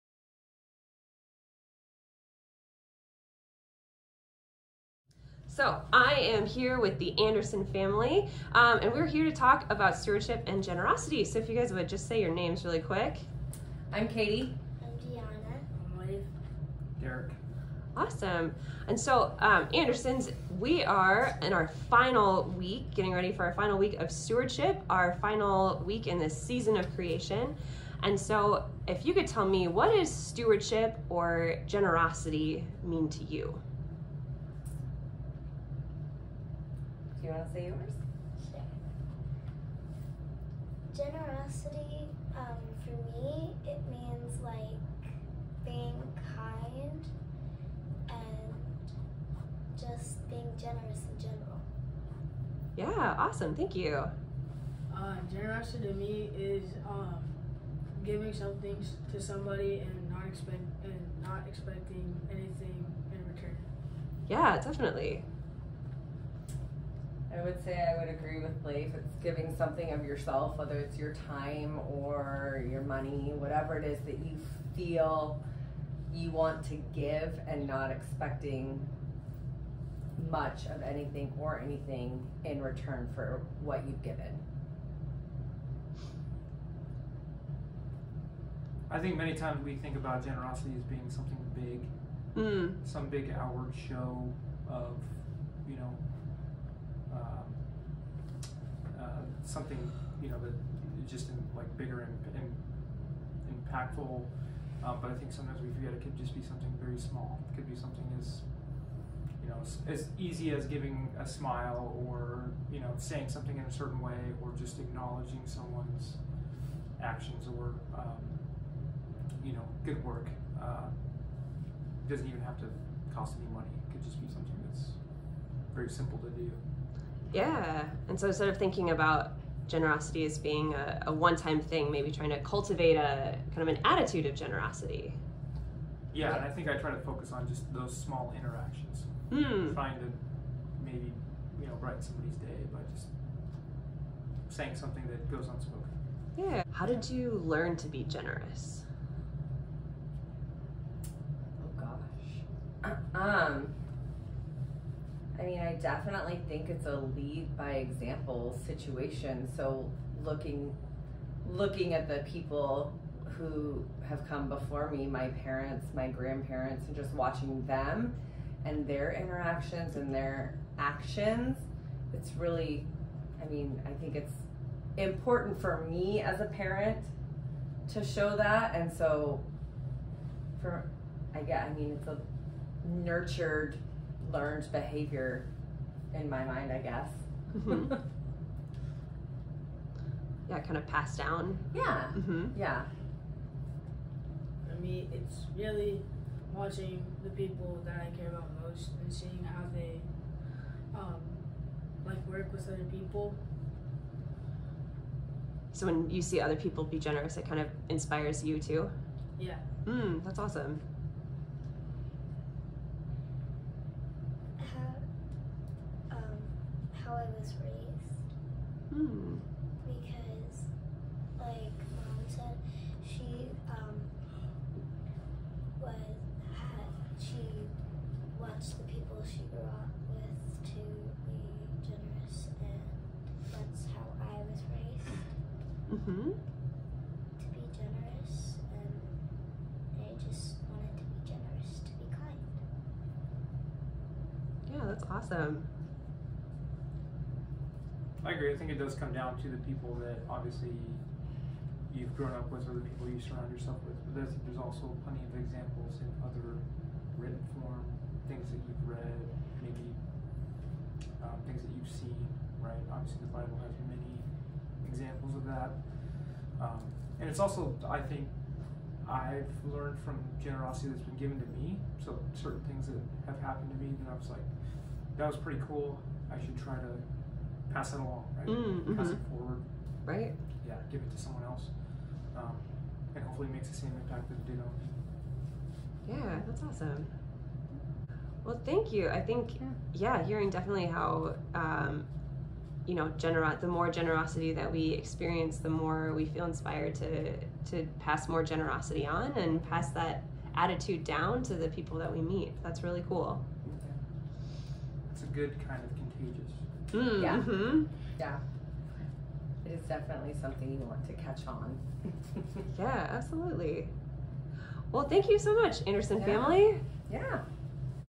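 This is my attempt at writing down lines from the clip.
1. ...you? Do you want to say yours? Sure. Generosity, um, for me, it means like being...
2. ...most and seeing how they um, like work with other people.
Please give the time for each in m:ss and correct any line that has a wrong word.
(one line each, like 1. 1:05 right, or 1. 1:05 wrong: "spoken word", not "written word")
1. 0:33 right
2. 3:18 right.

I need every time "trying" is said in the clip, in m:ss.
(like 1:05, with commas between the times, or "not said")
2:12, 2:19.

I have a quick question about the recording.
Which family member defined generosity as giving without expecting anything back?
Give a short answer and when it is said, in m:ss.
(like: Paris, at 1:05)
Blake, at 1:08.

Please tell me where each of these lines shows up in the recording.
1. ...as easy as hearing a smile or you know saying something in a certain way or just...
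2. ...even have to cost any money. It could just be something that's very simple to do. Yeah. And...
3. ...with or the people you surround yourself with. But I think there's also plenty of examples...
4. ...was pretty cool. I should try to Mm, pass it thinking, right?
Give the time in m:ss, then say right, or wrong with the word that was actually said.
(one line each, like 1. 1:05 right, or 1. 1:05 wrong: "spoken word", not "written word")
1. 1:49 wrong: "giving", not "hearing"
2. 2:02 right
3. 4:12 right
4. 4:35 wrong: "along", not "thinking".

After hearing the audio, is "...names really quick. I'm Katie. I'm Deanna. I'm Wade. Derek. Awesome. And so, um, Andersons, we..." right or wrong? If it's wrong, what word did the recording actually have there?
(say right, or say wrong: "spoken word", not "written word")
right.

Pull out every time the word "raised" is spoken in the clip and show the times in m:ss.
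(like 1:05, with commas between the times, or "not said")
3:37, 3:54.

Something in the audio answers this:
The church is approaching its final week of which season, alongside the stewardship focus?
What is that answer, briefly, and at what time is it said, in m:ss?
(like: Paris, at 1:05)
season of creation, at 0:26.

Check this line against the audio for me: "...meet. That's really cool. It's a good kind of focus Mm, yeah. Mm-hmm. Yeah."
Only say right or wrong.
wrong.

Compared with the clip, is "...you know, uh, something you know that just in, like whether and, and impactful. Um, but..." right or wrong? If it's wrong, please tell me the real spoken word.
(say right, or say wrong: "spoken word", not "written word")
wrong: "bigger", not "whether".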